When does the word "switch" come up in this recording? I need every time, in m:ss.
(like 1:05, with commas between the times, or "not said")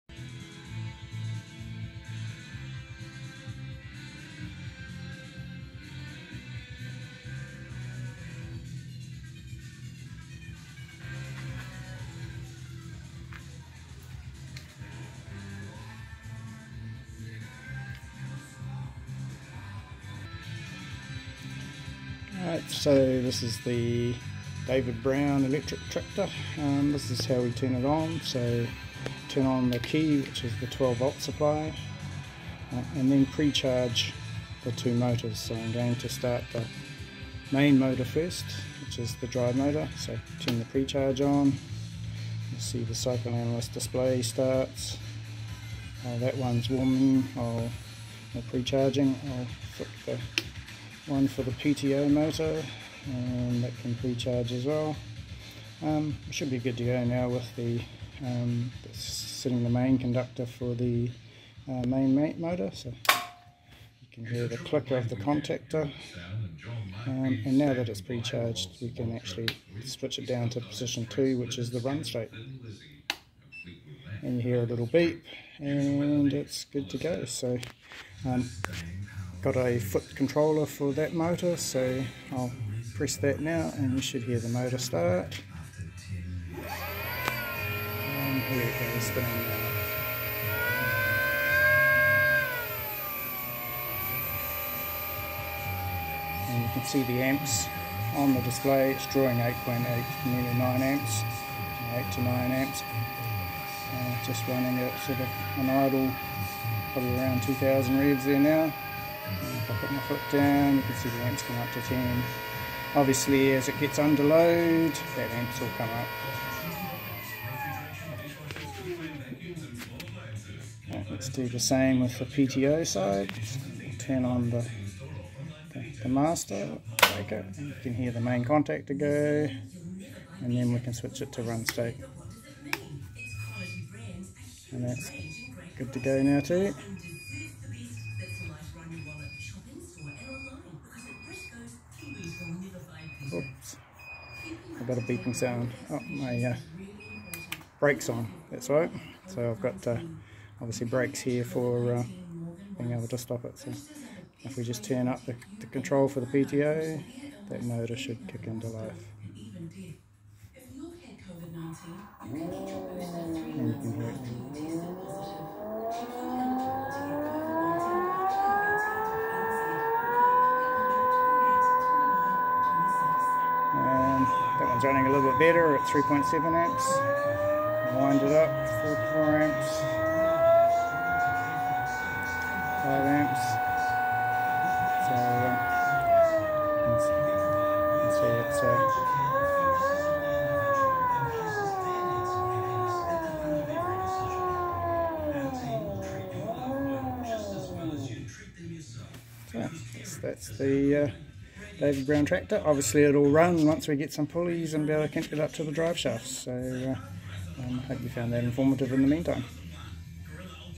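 1:09, 2:10.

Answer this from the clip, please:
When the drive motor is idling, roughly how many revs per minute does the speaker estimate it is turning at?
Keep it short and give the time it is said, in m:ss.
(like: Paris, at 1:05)
2,000, at 1:47.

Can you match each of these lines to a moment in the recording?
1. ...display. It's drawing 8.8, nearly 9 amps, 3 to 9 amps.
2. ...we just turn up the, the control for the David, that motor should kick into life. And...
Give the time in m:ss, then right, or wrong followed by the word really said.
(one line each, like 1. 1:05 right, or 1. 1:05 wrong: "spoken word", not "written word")
1. 1:38 wrong: "8", not "3"
2. 2:34 wrong: "PTO", not "David".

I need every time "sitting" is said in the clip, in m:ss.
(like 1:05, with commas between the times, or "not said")
0:58.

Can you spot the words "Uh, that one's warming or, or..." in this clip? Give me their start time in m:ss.
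0:46.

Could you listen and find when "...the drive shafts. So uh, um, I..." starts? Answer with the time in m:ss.
3:25.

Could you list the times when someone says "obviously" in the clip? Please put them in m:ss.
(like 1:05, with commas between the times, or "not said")
1:52, 2:30, 3:22.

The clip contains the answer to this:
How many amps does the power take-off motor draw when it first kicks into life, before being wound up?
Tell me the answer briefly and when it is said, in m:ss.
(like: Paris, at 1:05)
3.7 amps, at 2:55.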